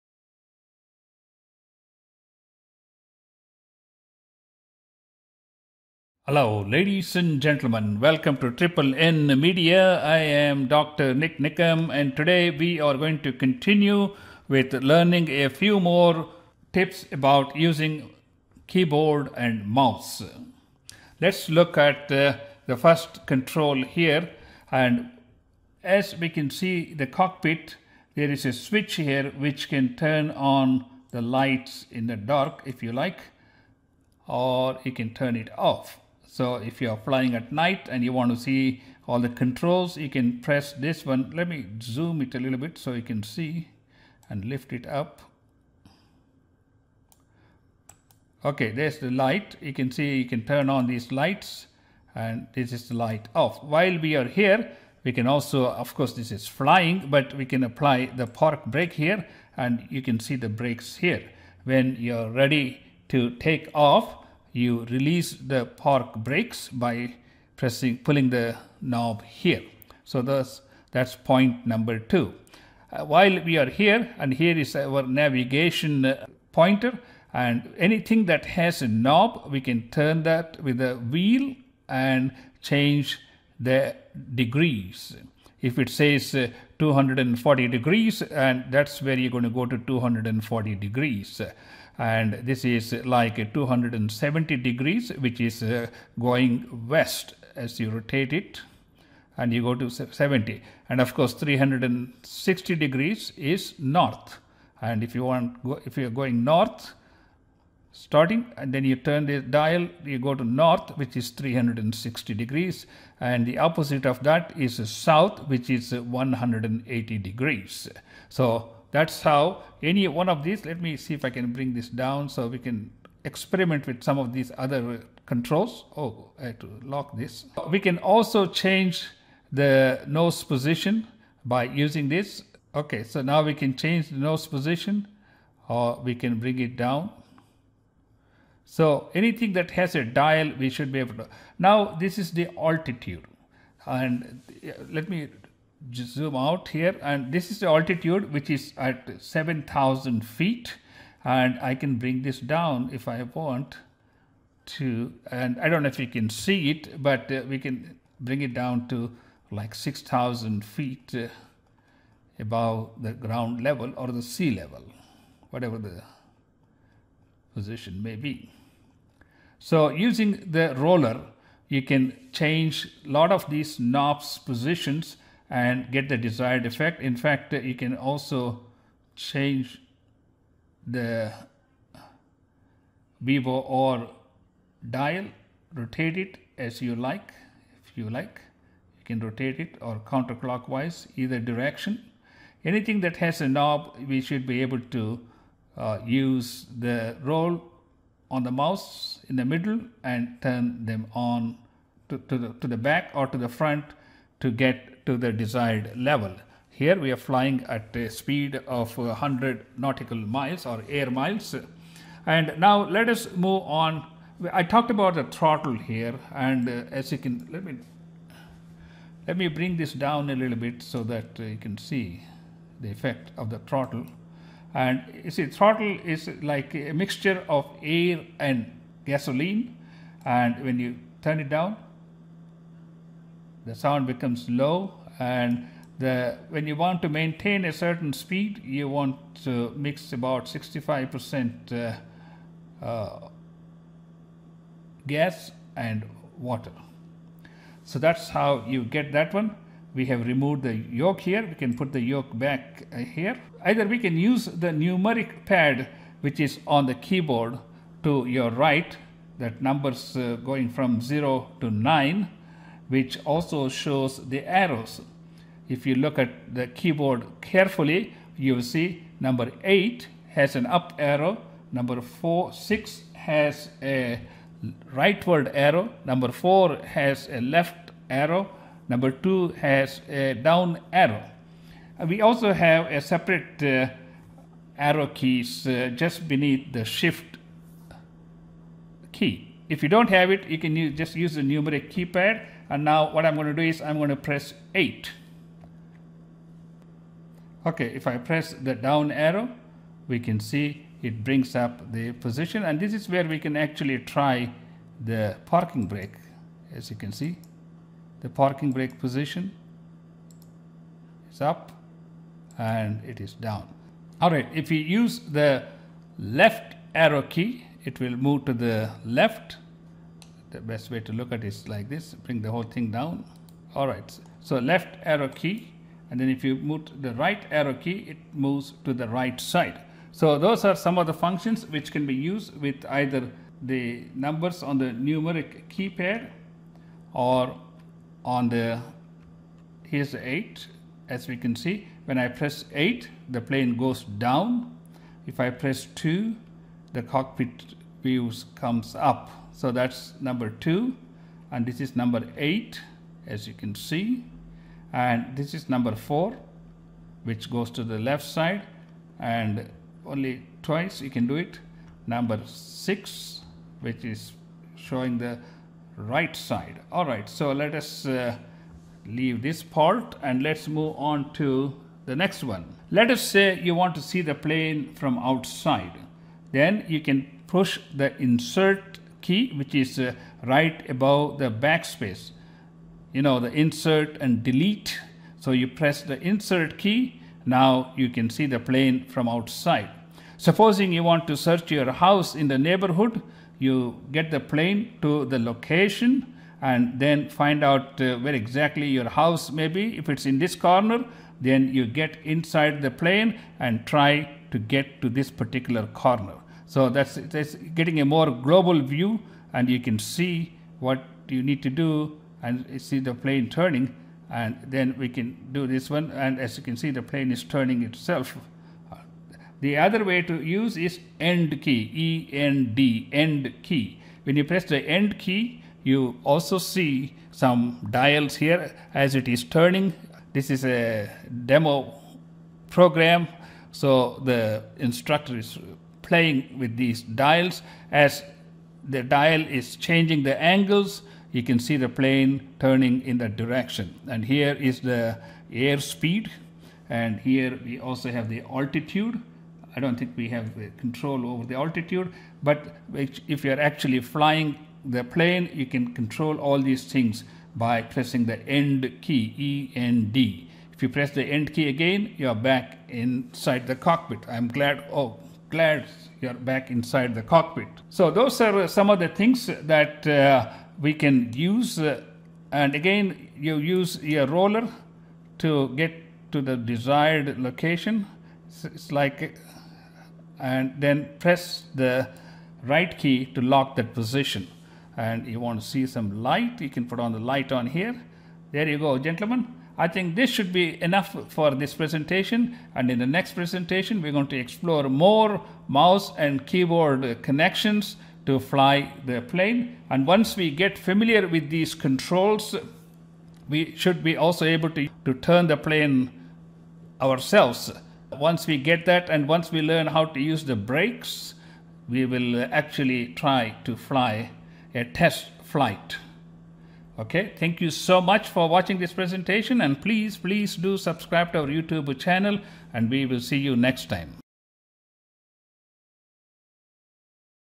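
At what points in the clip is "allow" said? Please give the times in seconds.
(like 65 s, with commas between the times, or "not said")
not said.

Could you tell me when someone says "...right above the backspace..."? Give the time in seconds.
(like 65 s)
380 s.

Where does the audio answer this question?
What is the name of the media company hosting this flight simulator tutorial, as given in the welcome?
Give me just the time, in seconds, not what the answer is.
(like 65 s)
8 s.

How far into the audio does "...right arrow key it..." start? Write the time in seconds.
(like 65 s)
327 s.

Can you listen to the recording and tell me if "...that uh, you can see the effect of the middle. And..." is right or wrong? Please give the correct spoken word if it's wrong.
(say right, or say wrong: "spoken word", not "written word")
wrong: "throttle", not "middle".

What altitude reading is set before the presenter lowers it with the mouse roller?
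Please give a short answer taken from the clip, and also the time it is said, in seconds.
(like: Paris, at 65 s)
7000 feet, at 149 s.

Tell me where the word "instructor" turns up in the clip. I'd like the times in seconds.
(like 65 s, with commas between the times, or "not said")
434 s.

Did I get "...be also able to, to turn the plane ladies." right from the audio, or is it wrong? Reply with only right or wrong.
wrong.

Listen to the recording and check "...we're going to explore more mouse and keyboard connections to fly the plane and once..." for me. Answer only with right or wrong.
right.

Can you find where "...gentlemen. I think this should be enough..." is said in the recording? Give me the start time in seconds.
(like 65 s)
488 s.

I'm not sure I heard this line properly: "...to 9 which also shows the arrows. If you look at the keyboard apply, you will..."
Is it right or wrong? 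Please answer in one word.
wrong.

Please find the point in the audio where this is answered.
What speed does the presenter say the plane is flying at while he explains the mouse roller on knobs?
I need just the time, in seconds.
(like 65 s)
208 s.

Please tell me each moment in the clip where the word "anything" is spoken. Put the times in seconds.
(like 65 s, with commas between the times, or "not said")
77 s, 139 s, 192 s.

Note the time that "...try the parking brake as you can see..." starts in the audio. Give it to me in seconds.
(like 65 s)
303 s.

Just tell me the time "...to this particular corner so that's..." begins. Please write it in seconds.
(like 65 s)
405 s.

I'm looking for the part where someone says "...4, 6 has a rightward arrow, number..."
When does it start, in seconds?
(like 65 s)
272 s.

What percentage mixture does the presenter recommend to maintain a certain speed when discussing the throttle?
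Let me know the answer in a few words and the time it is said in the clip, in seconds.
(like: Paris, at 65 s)
65%, at 240 s.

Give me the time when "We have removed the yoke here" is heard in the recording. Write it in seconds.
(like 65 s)
249 s.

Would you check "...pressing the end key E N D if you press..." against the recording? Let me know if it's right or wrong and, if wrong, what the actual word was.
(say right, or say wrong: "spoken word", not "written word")
right.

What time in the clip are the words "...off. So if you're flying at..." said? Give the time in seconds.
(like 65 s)
35 s.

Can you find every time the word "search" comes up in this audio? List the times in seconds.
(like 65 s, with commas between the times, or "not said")
391 s.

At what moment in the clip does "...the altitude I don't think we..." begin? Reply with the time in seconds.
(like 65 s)
448 s.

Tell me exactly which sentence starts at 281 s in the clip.
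Uh, we also have a separate uh, arrow keys uh, just beneath the shift key.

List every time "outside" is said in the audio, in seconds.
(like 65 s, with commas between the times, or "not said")
375 s, 389 s.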